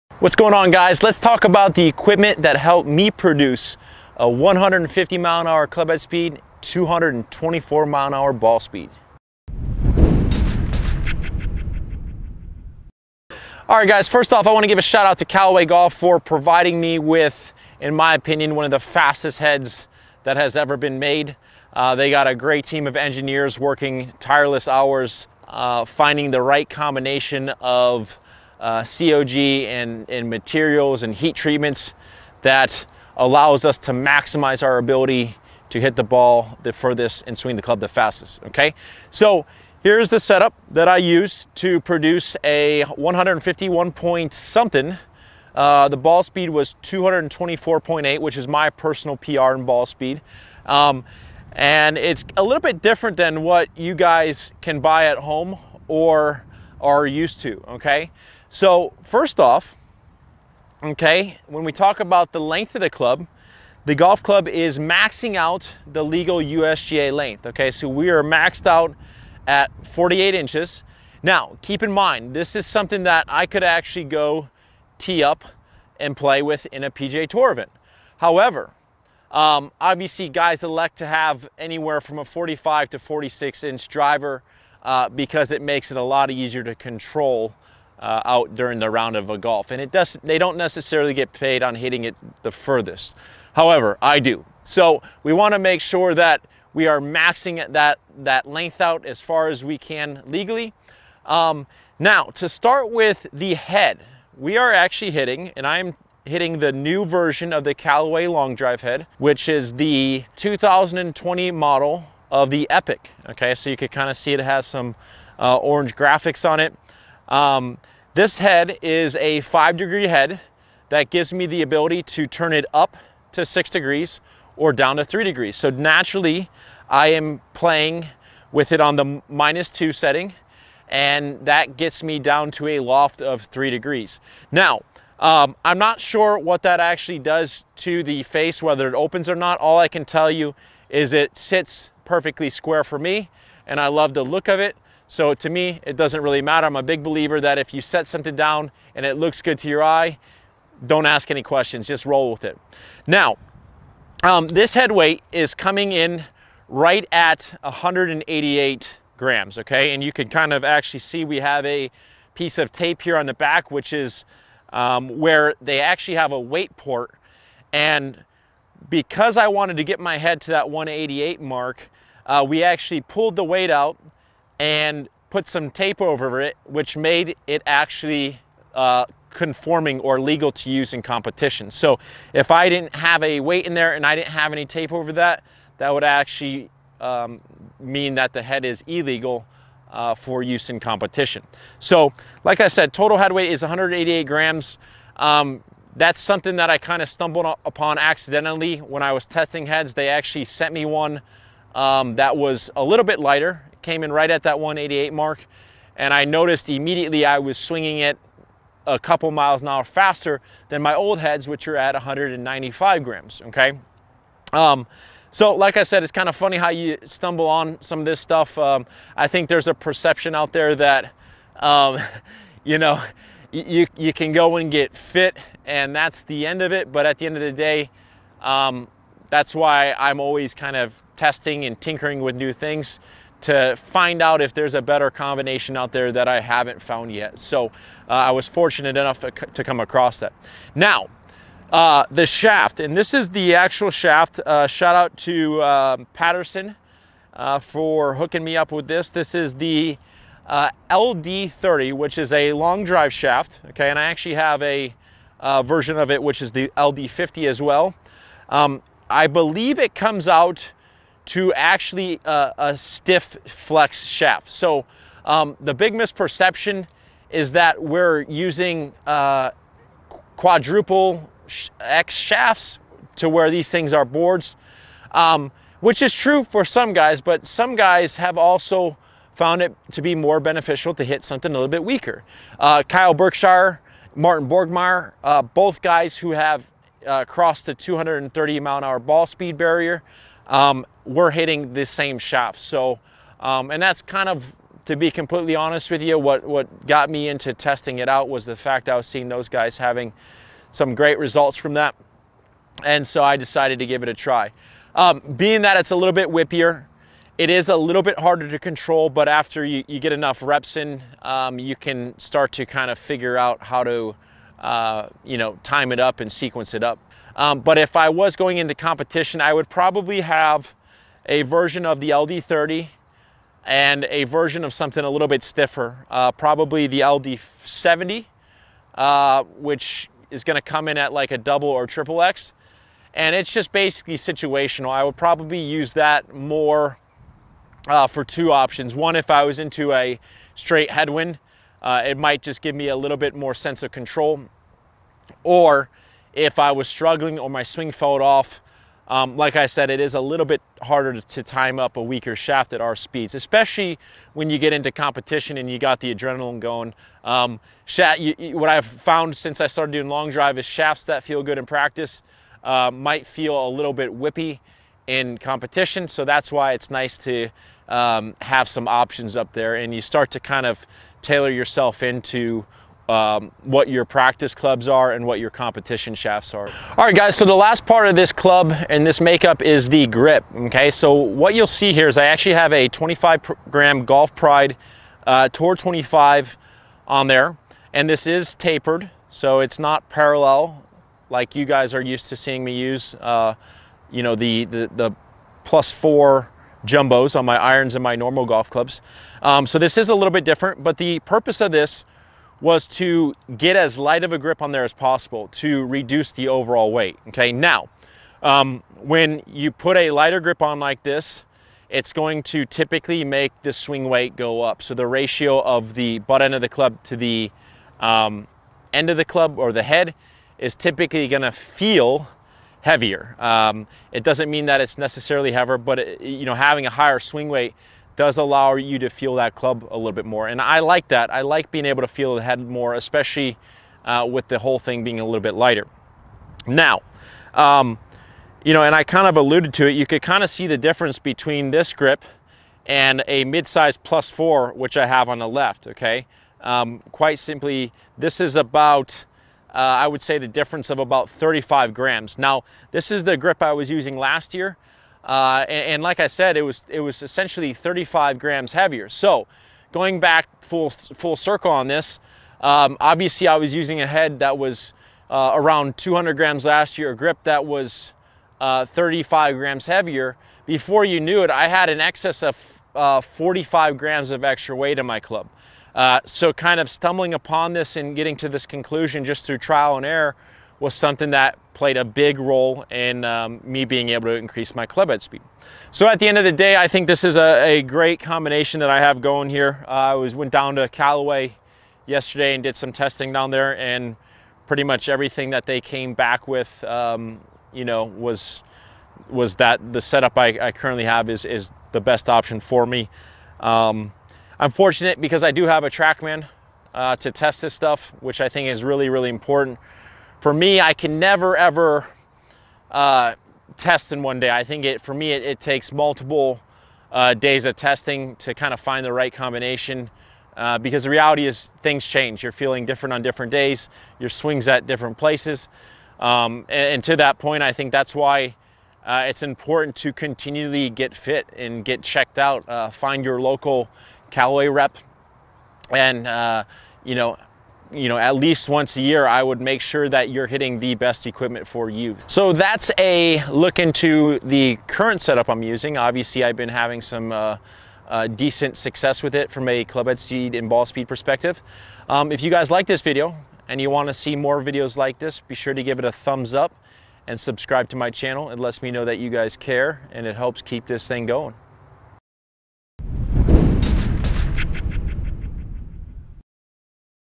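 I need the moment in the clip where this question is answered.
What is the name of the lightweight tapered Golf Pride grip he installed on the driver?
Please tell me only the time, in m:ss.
6:25.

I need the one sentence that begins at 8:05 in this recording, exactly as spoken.
So at the end of the day, I think this is a, a great combination that I have going here.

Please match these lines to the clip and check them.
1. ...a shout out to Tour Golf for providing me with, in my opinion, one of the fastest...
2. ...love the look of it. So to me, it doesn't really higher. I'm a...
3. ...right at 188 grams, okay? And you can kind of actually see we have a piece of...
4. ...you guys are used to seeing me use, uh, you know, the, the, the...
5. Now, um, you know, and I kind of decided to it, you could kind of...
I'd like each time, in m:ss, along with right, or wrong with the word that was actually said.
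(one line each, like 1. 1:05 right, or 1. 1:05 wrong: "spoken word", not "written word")
1. 0:14 wrong: "Callaway", not "Tour"
2. 2:23 wrong: "matter", not "higher"
3. 2:36 right
4. 6:31 right
5. 7:16 wrong: "alluded", not "decided".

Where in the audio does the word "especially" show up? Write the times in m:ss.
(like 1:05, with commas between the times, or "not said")
5:53, 7:12.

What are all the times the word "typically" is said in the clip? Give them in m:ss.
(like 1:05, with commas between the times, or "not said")
6:52, 7:00.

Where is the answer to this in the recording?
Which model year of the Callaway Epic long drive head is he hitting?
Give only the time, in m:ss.
1:50.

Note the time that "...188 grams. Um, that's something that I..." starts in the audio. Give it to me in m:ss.
3:13.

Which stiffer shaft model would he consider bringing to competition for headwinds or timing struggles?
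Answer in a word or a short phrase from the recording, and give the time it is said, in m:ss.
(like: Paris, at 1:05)
LD70, at 5:27.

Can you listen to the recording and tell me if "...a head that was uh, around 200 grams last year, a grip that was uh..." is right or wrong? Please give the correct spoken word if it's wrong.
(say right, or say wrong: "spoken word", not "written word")
right.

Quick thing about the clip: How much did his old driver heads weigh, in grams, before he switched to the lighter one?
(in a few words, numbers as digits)
195 grams.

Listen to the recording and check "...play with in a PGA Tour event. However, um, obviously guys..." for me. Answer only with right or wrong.
right.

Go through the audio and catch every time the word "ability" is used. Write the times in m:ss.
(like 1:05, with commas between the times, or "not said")
0:34, 2:01.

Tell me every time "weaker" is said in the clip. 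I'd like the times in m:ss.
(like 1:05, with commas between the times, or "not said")
4:41, 5:52.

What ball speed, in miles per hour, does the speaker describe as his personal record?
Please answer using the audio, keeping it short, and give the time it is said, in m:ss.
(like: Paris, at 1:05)
224.8, at 0:46.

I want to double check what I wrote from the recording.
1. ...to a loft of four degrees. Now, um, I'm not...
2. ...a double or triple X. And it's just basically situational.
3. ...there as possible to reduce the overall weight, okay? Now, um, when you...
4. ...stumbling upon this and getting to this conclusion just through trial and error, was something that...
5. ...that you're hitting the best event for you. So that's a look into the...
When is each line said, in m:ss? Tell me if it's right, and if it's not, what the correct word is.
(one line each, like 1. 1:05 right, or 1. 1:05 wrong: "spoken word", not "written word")
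1. 2:12 wrong: "three", not "four"
2. 5:31 right
3. 6:44 right
4. 7:56 right
5. 9:00 wrong: "equipment", not "event".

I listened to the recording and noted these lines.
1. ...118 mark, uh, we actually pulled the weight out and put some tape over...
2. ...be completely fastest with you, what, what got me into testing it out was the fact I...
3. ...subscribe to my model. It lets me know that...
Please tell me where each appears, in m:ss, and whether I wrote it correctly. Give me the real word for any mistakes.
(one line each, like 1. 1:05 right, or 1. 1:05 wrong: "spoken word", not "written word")
1. 2:50 wrong: "188", not "118"
2. 4:54 wrong: "honest", not "fastest"
3. 9:17 wrong: "channel", not "model".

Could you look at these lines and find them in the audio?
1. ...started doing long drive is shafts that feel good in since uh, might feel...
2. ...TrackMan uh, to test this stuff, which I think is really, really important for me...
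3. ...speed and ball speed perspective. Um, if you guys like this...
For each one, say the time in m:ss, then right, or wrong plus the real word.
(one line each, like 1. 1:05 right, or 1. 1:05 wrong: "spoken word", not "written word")
1. 5:59 wrong: "practice", not "since"
2. 8:25 right
3. 9:10 right.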